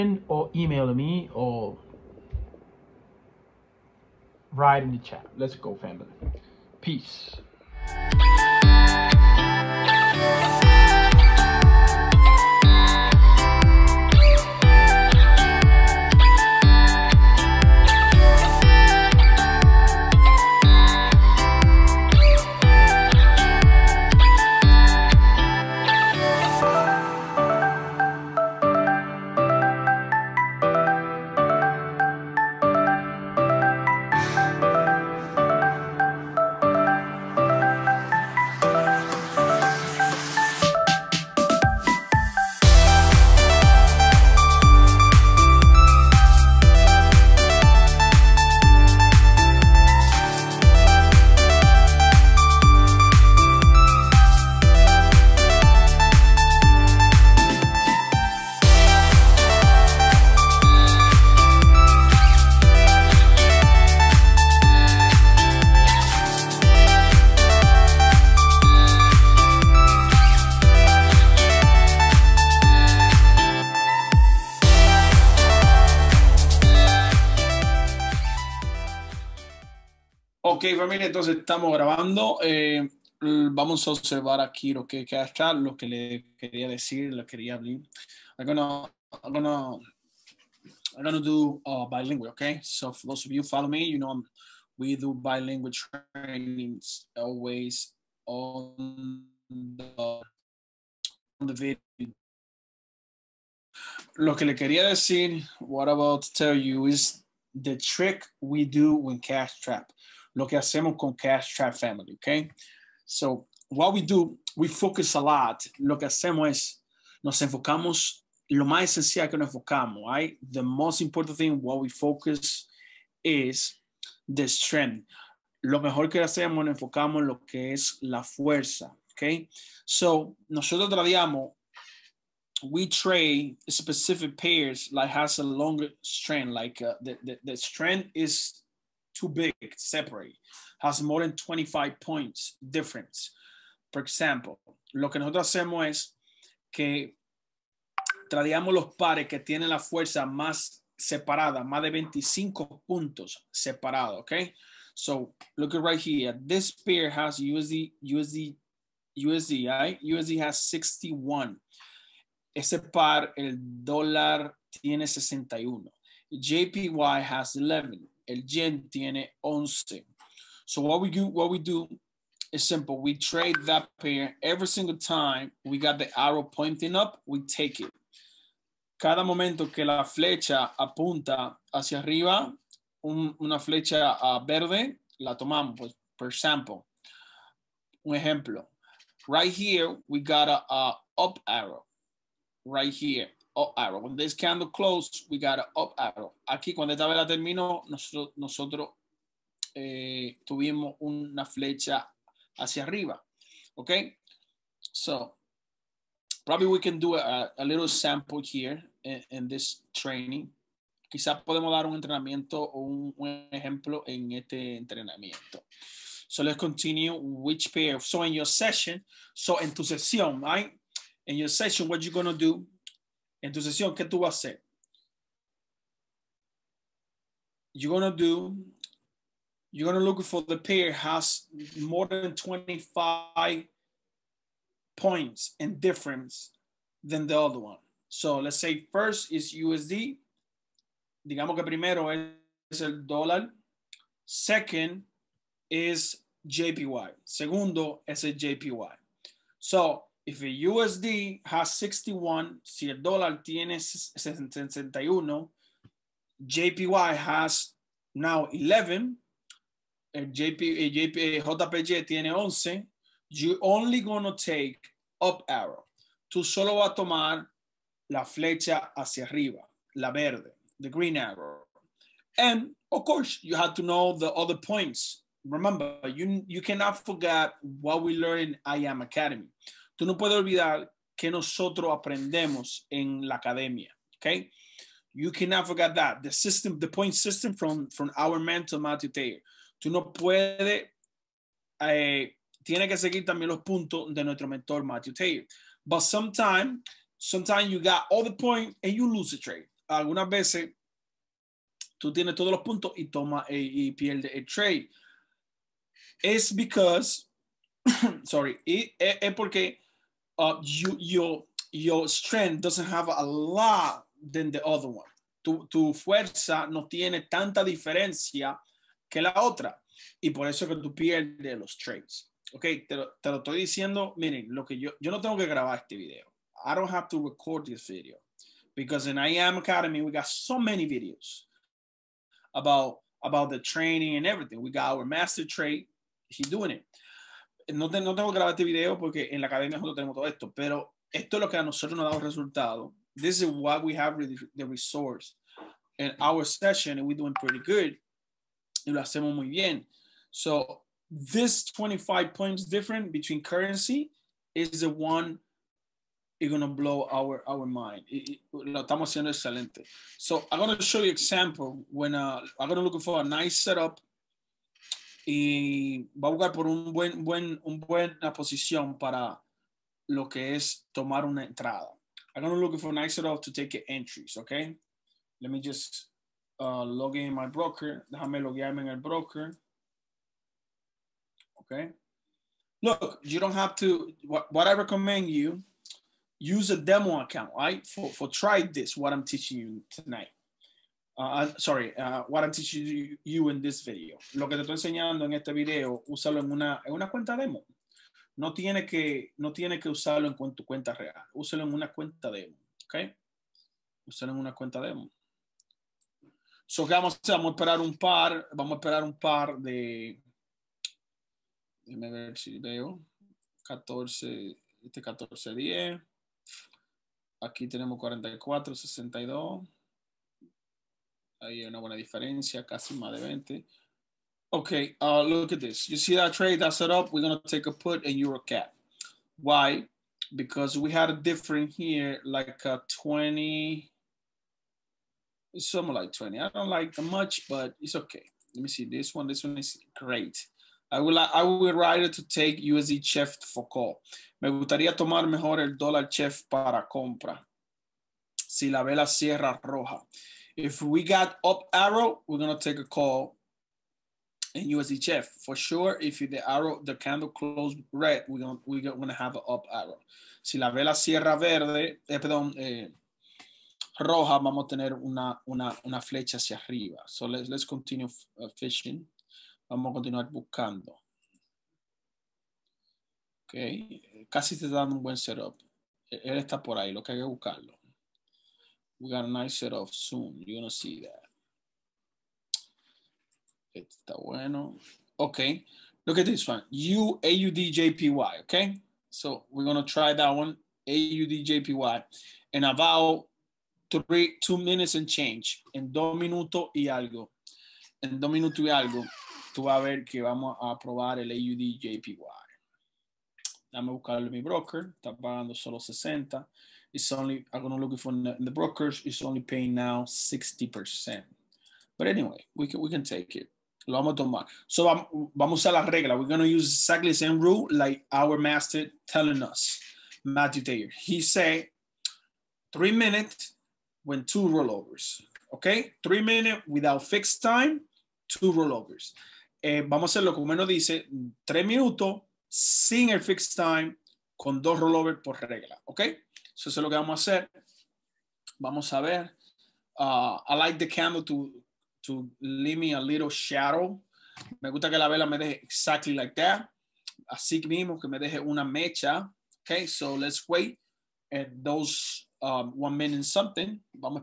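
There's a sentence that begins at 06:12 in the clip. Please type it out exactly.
I'm gonna look for an exit off to take entries, okay?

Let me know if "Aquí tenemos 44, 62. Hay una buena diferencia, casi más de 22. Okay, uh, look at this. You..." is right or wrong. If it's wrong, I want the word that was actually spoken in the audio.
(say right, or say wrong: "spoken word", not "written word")
wrong: "20", not "22".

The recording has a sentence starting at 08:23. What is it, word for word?
buscarlo buscarle mi broker, está pagando solo 60.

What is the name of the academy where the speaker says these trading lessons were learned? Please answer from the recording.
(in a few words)
I Am Academy.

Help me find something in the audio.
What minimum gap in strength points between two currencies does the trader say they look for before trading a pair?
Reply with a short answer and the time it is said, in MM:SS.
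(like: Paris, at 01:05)
25, at 02:21.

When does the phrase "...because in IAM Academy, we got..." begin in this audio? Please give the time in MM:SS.
05:28.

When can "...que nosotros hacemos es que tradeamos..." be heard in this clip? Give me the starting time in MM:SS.
02:25.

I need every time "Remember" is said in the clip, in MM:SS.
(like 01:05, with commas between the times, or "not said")
04:35.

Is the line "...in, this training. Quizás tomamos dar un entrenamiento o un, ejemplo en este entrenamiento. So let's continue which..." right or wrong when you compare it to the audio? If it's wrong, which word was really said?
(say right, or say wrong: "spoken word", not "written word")
wrong: "podemos", not "tomamos".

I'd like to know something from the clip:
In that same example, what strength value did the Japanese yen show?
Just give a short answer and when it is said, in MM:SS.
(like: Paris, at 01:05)
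11, at 02:46.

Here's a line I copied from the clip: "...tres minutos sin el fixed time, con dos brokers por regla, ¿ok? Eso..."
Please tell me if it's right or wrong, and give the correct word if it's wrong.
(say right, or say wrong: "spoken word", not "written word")
wrong: "rollovers", not "brokers".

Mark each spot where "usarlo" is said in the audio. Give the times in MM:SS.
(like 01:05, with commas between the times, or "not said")
06:39.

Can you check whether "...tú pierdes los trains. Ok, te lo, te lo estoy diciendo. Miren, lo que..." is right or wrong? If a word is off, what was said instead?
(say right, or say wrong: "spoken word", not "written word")
right.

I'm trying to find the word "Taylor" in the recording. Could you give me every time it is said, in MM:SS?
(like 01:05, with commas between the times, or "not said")
04:49, 04:55, 08:40.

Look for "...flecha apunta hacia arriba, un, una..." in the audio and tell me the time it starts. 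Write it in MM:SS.
03:00.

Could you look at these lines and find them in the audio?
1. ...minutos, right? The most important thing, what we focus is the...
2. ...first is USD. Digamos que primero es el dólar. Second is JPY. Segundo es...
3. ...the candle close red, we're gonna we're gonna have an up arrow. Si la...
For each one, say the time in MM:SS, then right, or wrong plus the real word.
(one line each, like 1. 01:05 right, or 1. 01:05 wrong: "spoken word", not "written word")
1. 01:59 wrong: "enfocamos", not "minutos"
2. 03:58 right
3. 07:36 right.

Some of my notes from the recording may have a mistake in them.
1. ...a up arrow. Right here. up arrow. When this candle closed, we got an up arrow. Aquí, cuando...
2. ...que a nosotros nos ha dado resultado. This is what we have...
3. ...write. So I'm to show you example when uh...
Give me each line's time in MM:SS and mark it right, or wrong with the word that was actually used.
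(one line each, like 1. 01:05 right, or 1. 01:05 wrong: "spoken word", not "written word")
1. 03:10 right
2. 05:41 right
3. 05:59 wrong: "excelente", not "write".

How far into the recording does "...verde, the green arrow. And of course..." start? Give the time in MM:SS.
04:30.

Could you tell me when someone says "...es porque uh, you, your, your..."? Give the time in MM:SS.
05:08.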